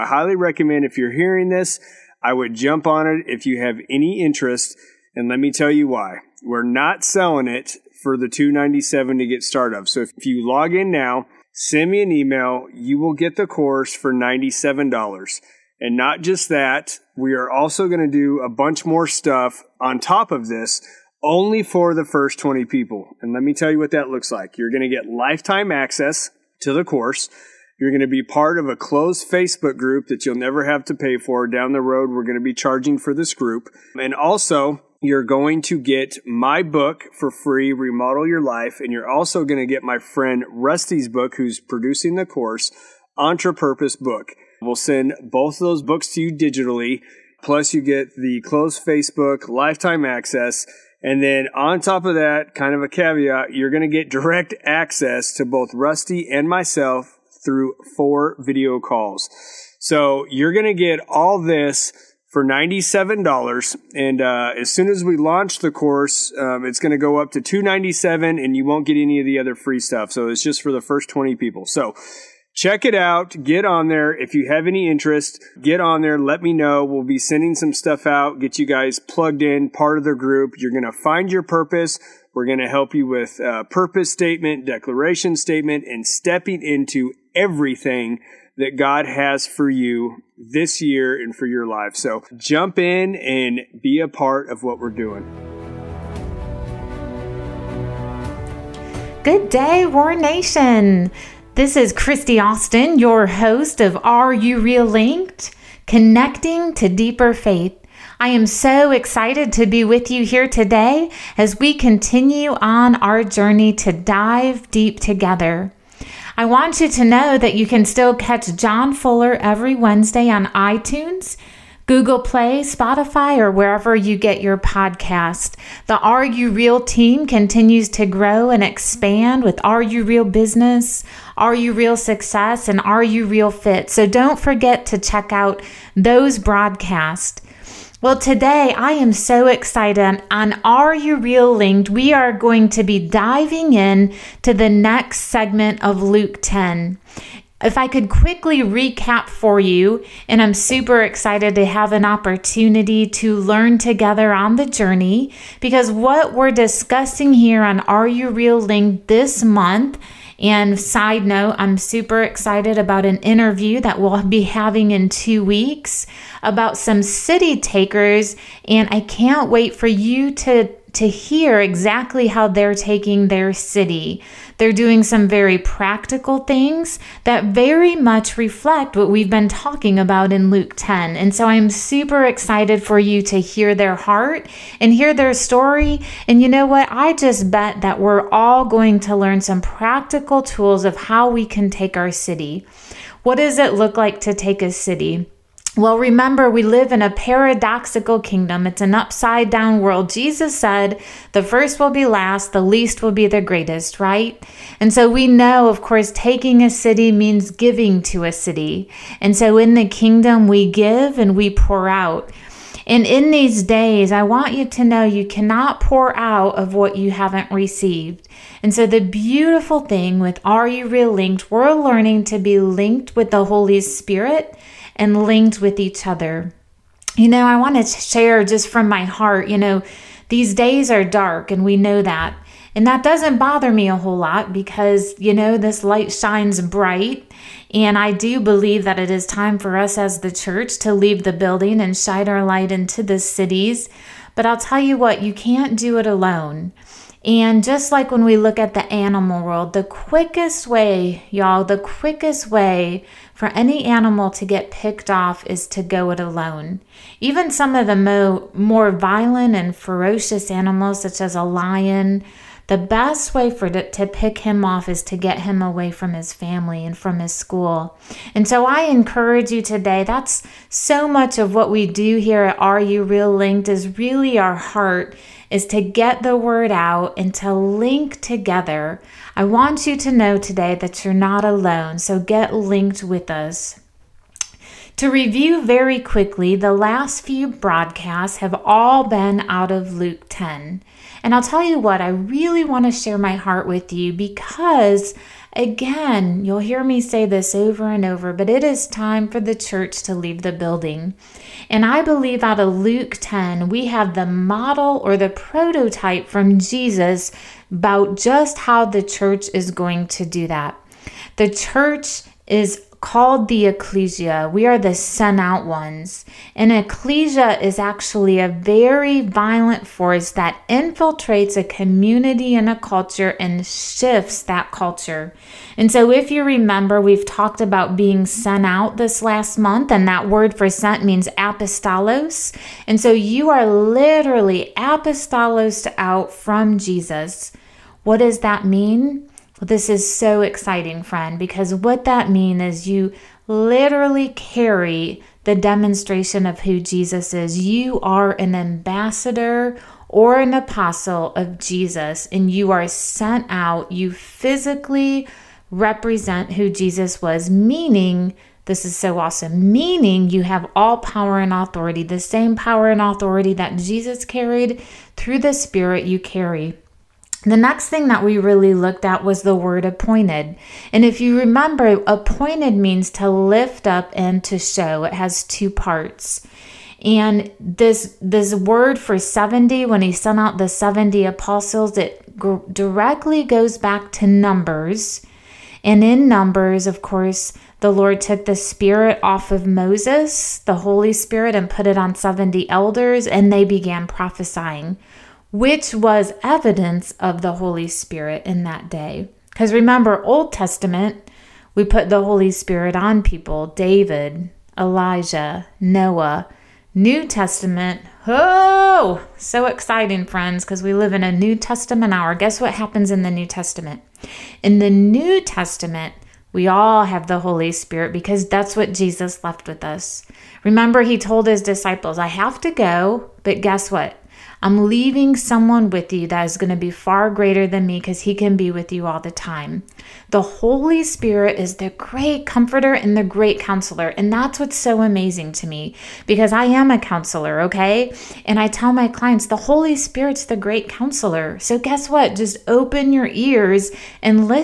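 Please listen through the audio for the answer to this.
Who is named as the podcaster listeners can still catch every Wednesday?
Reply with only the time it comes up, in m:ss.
1:58.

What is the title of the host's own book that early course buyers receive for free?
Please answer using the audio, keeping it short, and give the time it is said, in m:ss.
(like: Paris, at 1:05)
Remodel Your Life, at 0:37.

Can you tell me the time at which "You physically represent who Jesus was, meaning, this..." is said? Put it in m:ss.
5:53.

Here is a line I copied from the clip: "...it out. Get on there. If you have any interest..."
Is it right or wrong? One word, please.
right.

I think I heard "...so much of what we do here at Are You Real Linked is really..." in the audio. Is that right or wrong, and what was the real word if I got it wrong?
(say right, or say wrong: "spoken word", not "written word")
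right.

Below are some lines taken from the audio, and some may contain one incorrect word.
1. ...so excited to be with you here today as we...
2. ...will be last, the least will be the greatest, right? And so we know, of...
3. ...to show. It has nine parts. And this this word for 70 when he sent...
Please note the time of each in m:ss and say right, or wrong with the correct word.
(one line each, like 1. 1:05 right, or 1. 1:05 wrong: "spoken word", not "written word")
1. 1:48 right
2. 3:21 right
3. 6:14 wrong: "two", not "nine".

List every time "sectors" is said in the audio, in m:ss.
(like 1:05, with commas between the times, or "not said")
not said.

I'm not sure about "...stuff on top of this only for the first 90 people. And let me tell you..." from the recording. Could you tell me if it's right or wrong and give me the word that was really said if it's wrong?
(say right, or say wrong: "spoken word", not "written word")
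wrong: "20", not "90".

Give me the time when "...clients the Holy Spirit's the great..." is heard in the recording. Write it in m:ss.
7:19.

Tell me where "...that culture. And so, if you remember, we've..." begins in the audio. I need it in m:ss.
5:24.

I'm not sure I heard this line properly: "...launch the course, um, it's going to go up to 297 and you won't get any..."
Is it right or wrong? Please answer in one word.
right.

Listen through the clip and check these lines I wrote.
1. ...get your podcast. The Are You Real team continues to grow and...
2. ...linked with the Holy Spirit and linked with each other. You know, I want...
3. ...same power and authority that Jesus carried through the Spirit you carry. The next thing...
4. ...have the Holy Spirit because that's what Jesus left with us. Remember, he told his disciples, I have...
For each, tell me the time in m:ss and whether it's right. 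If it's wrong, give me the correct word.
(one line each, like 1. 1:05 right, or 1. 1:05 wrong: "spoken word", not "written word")
1. 2:04 right
2. 3:42 right
3. 6:02 right
4. 6:57 right.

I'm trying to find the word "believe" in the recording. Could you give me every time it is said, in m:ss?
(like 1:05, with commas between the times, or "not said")
3:58, 5:02.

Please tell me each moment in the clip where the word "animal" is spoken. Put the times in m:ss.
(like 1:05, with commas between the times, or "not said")
4:08, 4:13, 4:20.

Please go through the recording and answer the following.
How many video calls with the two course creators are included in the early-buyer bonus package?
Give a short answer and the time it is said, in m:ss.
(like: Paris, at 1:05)
4, at 0:57.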